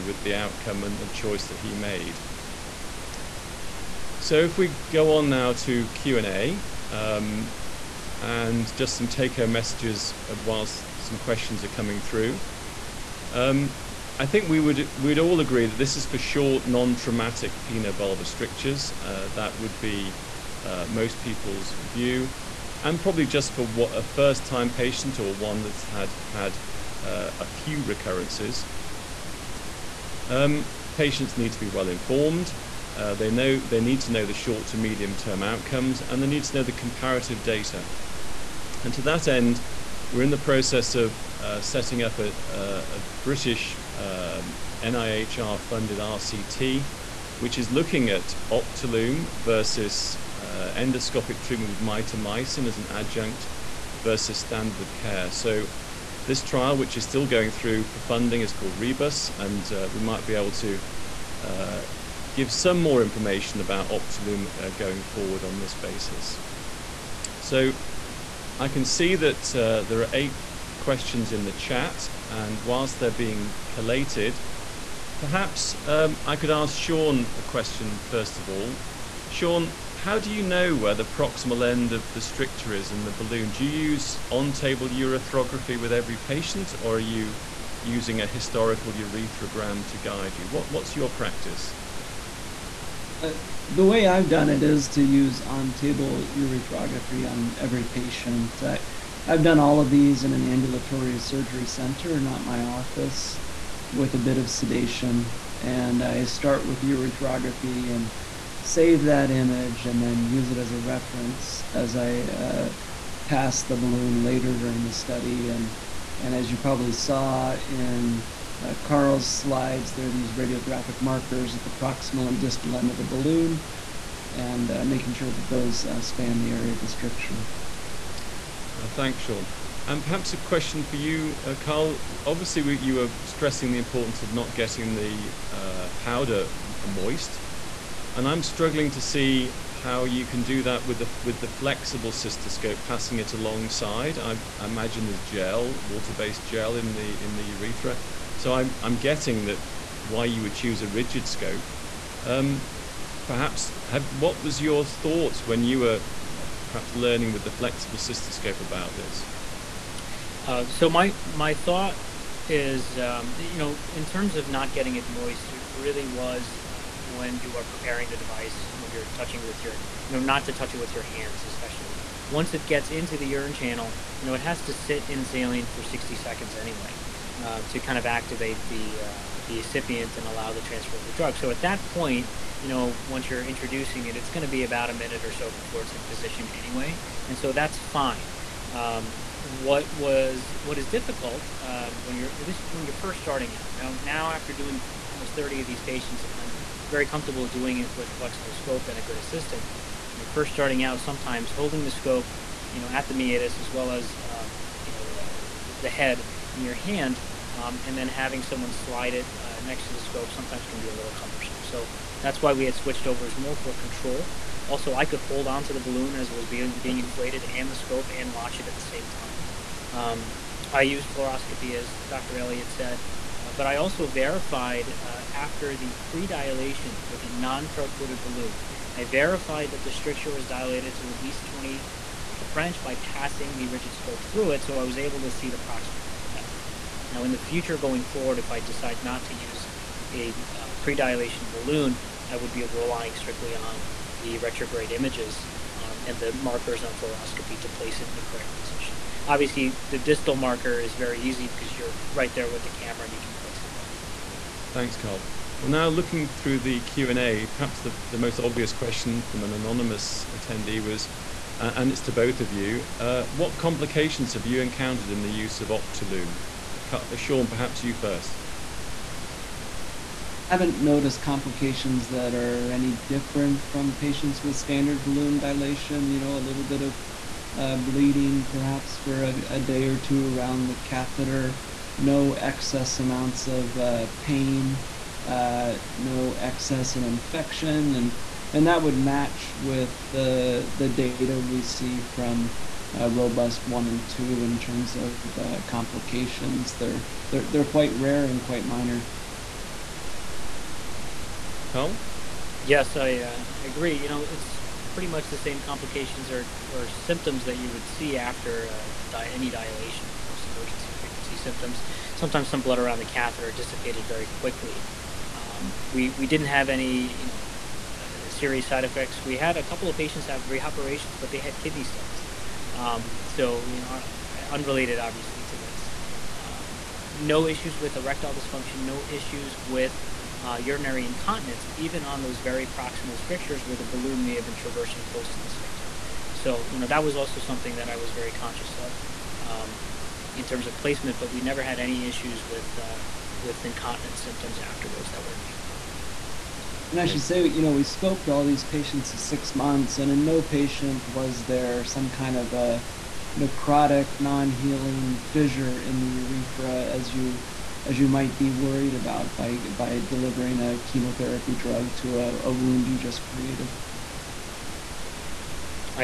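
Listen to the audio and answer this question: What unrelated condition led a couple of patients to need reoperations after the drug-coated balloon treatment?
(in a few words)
kidney stones.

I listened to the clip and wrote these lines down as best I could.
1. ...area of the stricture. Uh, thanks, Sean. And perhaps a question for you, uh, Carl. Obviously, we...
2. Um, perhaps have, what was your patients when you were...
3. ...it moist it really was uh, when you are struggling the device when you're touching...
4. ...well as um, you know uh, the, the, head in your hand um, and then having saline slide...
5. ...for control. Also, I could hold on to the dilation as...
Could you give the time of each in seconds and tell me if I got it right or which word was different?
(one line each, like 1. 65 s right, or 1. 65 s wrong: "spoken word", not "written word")
1. 126 s right
2. 152 s wrong: "thoughts", not "patients"
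3. 164 s wrong: "preparing", not "struggling"
4. 203 s wrong: "someone", not "saline"
5. 213 s wrong: "balloon", not "dilation".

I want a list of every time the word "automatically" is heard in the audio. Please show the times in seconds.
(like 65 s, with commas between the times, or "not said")
not said.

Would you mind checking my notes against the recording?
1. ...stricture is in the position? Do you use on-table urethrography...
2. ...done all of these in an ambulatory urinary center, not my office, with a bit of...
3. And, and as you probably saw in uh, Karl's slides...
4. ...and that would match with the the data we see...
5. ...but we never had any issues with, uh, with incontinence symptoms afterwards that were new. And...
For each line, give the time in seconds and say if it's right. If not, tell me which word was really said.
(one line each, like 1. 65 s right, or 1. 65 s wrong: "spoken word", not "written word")
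1. 82 s wrong: "balloon", not "position"
2. 99 s wrong: "surgery", not "urinary"
3. 115 s right
4. 288 s right
5. 341 s right.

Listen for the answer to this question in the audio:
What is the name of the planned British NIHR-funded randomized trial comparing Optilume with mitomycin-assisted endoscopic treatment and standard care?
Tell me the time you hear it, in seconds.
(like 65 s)
58 s.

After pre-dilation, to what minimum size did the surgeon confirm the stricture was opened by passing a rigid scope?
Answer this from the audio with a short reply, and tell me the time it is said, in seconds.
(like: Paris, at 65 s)
20 French, at 231 s.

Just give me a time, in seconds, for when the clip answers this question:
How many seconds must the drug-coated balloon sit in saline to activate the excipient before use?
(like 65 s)
175 s.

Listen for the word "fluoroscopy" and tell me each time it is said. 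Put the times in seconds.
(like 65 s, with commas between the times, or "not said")
221 s, 246 s.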